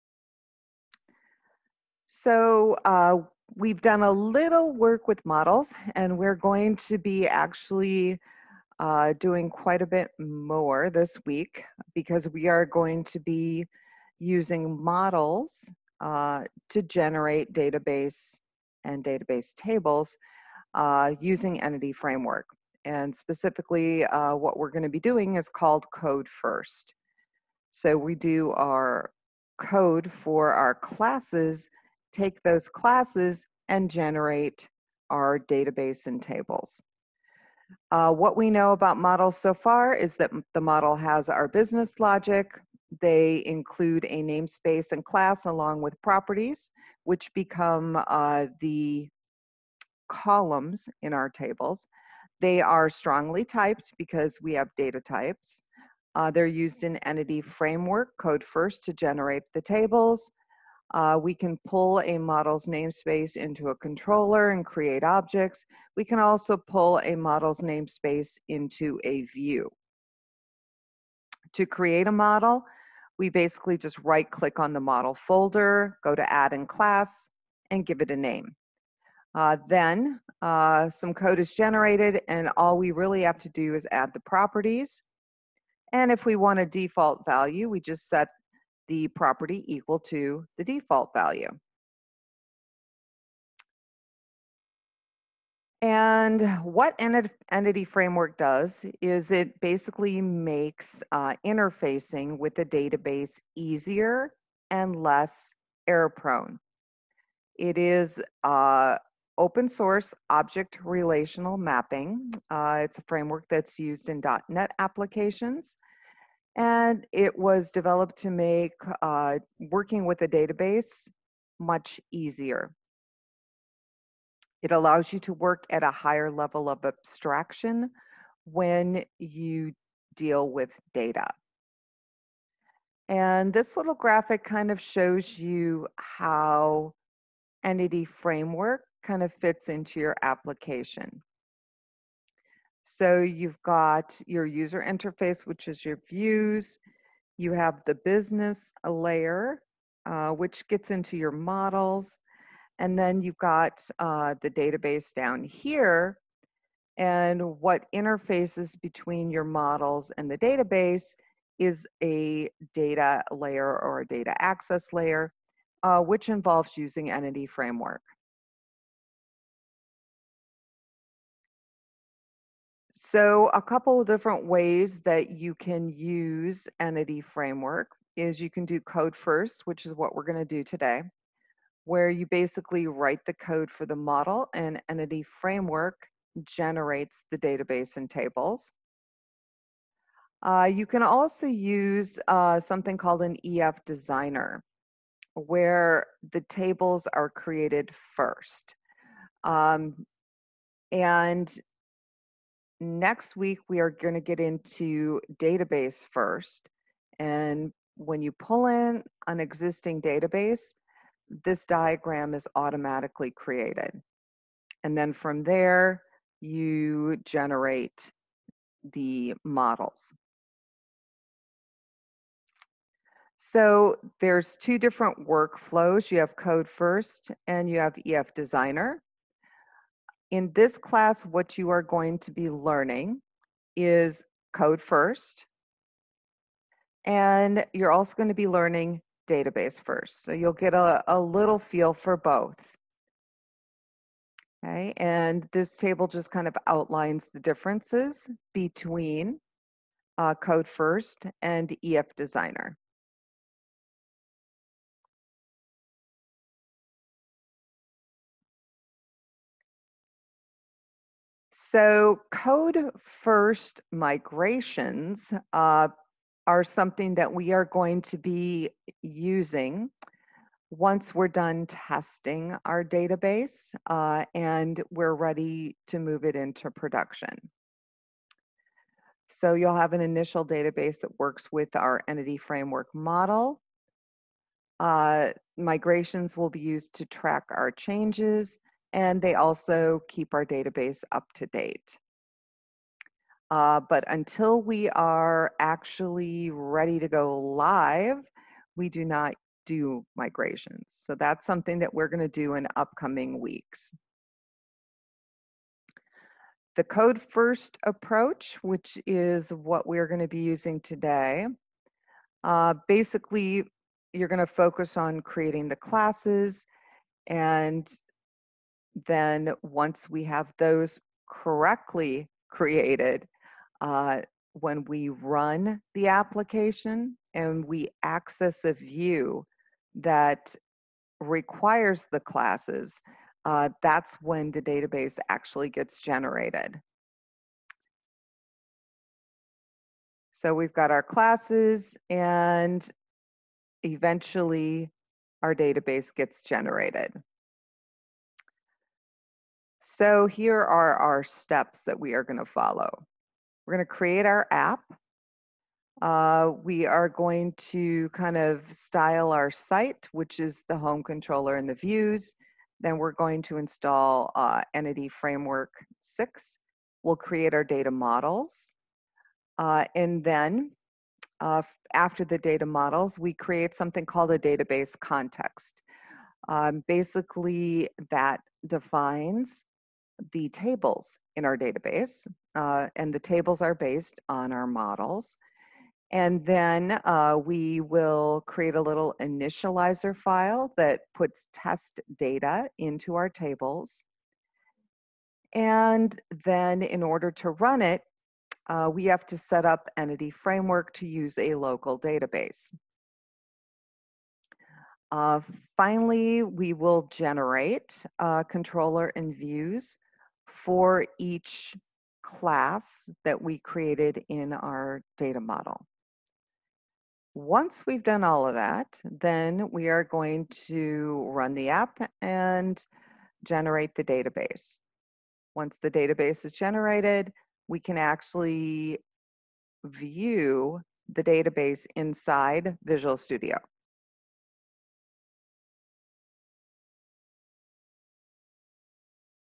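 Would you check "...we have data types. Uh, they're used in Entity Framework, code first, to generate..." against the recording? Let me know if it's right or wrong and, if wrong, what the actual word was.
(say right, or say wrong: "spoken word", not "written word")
right.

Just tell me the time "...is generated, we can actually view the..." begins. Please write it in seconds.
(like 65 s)
426 s.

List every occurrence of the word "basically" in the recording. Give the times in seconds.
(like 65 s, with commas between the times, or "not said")
73 s, 99 s, 182 s, 312 s, 376 s.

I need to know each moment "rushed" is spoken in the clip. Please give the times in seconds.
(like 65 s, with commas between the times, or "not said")
not said.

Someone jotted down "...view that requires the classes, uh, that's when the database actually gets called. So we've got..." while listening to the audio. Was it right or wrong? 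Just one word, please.
wrong.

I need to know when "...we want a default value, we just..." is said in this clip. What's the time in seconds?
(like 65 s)
86 s.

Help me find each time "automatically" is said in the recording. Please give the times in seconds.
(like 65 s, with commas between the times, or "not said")
212 s.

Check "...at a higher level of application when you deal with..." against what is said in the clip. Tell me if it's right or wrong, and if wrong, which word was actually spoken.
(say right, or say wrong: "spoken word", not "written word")
wrong: "abstraction", not "application".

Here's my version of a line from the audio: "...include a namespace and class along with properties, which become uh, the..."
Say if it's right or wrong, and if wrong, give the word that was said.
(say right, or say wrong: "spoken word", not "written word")
right.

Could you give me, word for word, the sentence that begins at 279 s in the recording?
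So, you'll have an initial database that works with our entity framework model.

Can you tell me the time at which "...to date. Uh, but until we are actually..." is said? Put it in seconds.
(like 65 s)
291 s.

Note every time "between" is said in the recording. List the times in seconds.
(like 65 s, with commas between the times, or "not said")
158 s, 248 s.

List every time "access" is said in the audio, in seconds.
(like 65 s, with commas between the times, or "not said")
164 s, 328 s.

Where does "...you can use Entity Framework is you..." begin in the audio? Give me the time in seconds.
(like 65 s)
175 s.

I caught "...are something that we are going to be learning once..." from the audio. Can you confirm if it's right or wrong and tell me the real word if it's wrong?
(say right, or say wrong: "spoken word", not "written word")
wrong: "using", not "learning".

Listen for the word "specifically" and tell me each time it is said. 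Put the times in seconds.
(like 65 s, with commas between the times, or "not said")
23 s.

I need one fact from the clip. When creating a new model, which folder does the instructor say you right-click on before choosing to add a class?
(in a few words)
model folder.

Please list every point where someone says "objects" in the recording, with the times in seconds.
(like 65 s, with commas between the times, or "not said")
65 s, 110 s.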